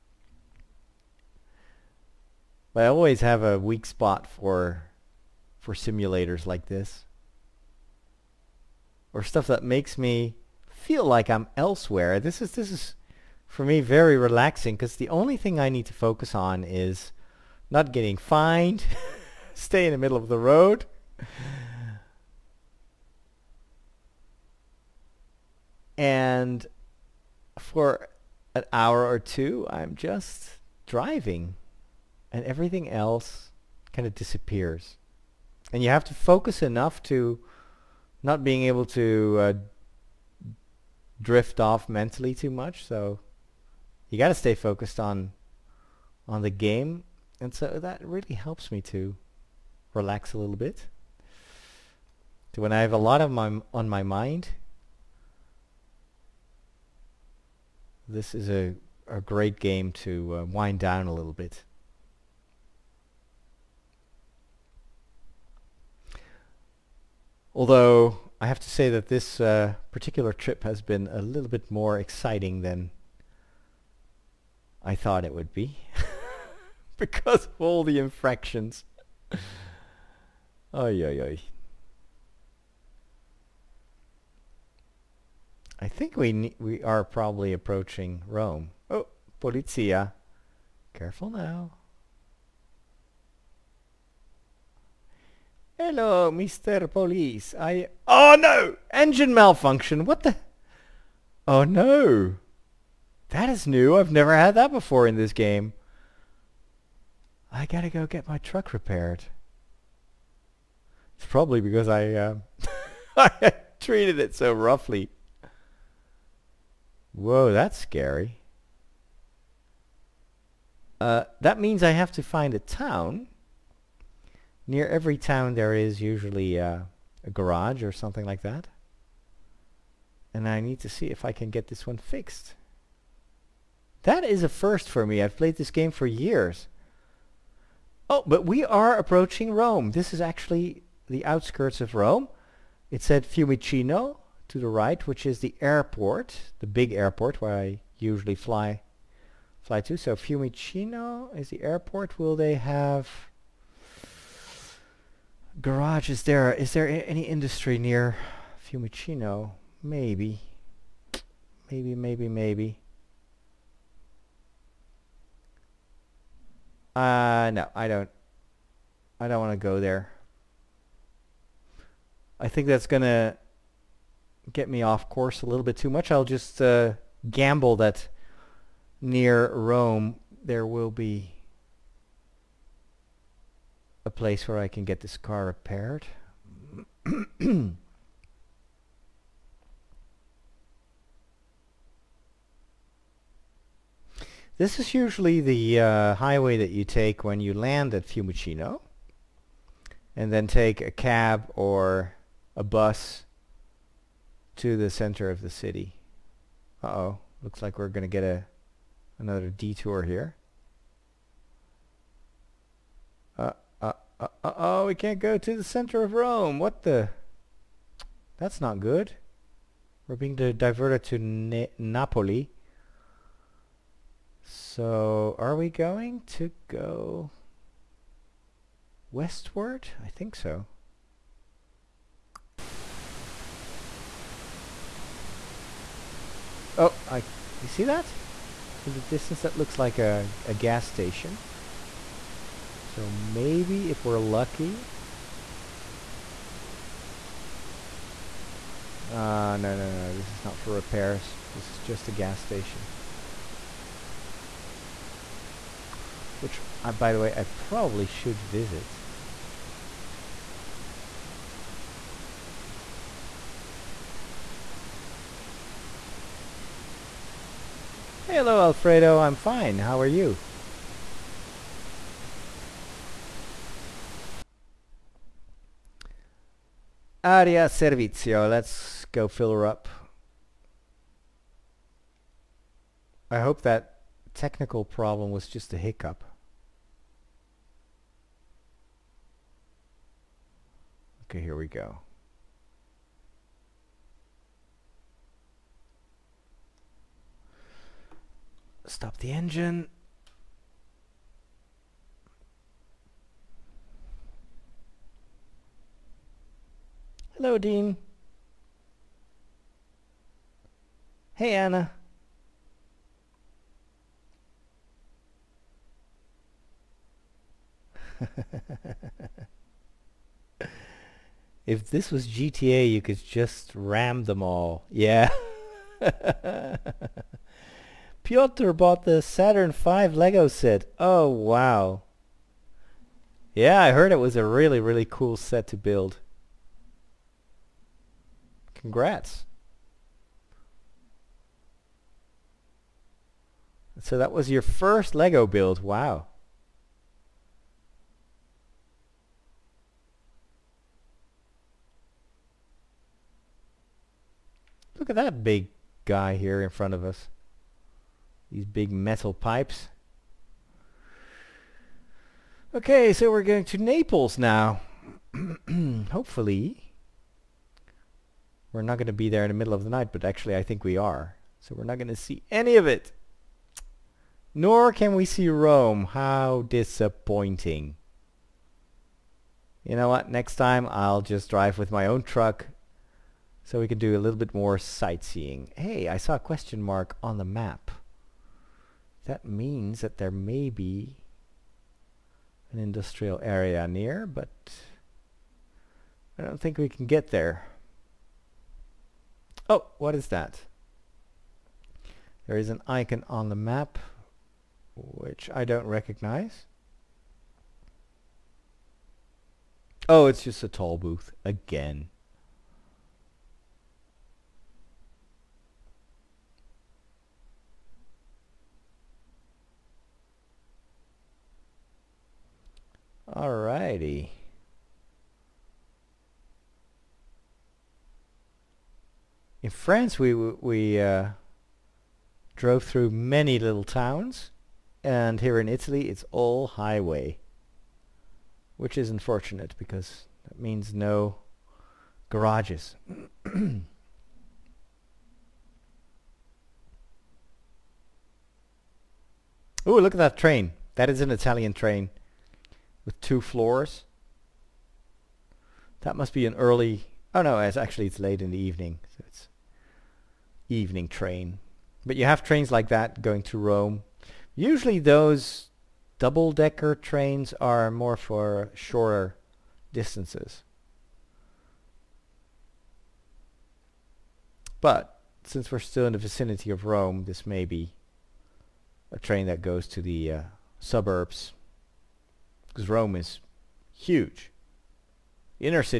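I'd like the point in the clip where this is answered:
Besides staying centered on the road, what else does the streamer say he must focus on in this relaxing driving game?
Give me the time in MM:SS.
00:17.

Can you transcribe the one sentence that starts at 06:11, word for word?
So we're not going to see any of it.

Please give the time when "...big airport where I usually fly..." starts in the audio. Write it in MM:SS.
02:26.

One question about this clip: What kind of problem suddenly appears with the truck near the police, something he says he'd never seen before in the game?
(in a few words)
Engine malfunction.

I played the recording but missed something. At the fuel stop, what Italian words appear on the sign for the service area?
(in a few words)
Area Servizio.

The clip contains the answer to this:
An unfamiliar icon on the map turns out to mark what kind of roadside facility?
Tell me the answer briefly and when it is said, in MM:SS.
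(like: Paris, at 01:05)
toll booth, at 06:50.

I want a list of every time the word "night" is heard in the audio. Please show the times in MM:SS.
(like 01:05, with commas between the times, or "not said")
06:09.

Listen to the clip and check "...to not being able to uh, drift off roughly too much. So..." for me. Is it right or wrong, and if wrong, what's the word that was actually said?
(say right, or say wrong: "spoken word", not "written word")
wrong: "mentally", not "roughly".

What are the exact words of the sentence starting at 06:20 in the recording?
Next time I'll just drive with my own truck so we can do a little bit more sightseeing.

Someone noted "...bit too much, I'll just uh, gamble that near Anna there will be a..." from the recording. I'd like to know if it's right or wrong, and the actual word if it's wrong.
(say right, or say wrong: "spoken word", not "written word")
wrong: "Rome", not "Anna".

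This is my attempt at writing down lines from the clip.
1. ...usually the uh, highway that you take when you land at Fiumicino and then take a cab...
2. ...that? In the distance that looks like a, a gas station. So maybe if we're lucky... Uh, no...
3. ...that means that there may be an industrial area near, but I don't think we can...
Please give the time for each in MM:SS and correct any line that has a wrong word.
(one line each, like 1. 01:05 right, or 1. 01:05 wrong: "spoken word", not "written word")
1. 03:14 right
2. 03:57 right
3. 06:29 right.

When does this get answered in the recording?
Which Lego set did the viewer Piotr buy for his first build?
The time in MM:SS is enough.
05:29.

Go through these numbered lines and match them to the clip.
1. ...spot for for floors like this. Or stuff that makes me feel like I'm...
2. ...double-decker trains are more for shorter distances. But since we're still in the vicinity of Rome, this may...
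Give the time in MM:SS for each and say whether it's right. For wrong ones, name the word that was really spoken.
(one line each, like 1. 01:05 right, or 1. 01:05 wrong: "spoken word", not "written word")
1. 00:03 wrong: "simulators", not "floors"
2. 07:46 right.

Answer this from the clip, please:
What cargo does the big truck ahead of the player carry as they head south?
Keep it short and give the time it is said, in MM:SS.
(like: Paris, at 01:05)
big metal pipes, at 05:58.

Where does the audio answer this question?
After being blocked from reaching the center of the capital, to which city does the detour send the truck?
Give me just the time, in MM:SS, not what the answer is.
03:41.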